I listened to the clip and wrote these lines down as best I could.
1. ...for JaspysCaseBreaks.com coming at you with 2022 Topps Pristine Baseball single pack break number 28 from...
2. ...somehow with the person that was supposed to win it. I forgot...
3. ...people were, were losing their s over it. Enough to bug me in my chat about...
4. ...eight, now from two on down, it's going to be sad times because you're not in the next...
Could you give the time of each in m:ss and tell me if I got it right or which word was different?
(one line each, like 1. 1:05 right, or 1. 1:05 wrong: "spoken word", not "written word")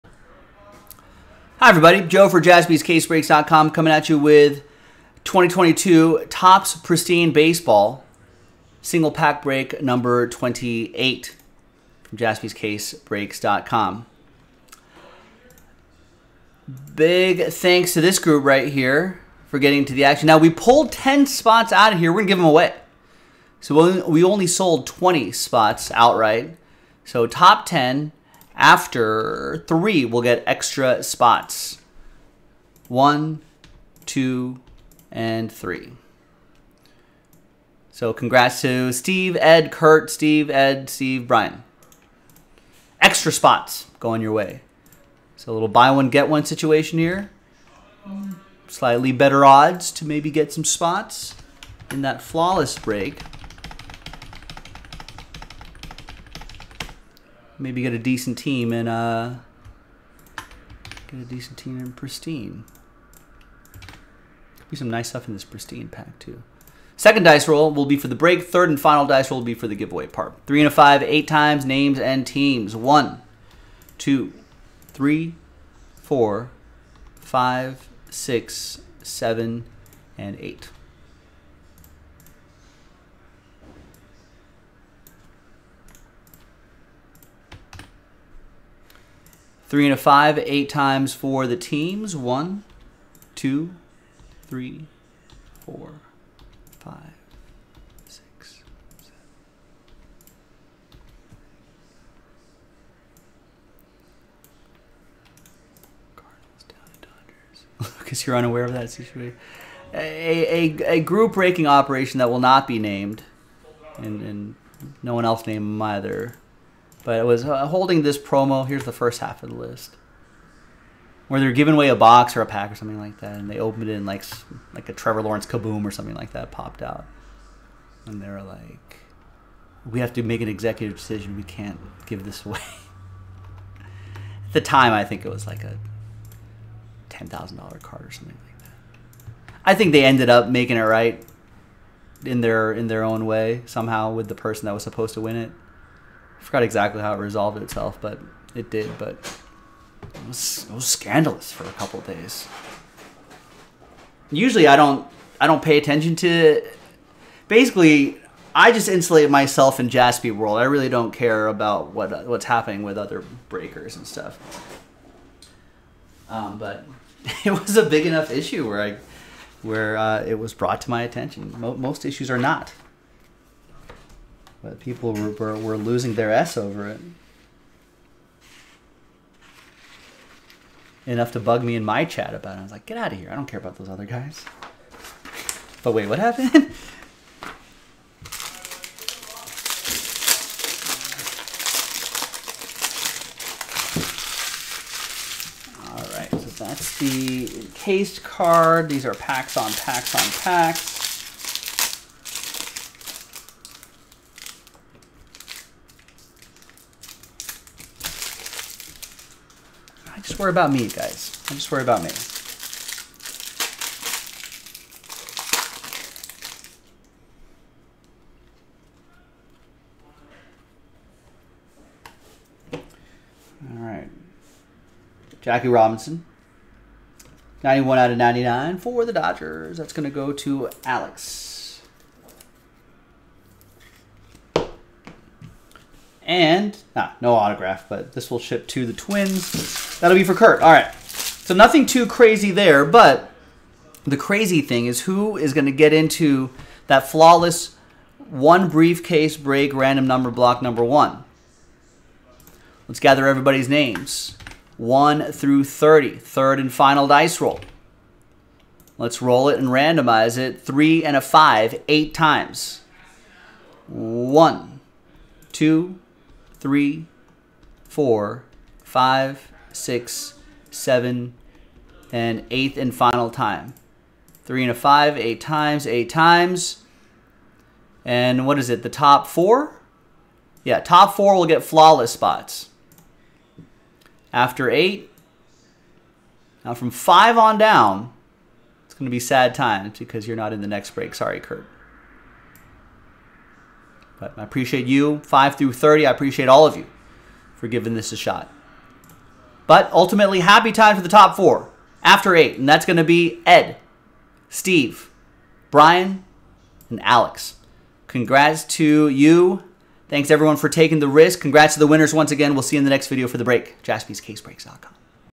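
1. 0:02 right
2. 2:23 right
3. 2:54 right
4. 4:44 wrong: "five", not "two".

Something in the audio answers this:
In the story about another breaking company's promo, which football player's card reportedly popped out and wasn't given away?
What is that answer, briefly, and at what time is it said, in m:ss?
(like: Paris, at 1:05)
Trevor Lawrence, at 2:04.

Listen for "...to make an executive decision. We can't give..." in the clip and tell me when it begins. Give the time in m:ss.
2:10.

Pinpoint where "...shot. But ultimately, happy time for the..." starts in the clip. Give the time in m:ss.
4:58.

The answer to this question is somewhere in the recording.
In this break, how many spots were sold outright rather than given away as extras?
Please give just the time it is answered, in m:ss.
0:24.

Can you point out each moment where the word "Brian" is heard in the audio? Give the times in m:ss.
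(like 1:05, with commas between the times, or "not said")
0:41, 5:05.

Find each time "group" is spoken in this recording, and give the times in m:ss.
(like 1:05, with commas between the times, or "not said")
0:18, 1:50.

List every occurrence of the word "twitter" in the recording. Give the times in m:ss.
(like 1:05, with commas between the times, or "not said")
not said.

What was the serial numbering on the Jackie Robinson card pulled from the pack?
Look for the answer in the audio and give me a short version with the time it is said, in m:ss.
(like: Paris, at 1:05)
91/99, at 3:47.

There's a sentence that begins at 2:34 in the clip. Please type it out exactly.
Usually, I don't I don't pay attention to.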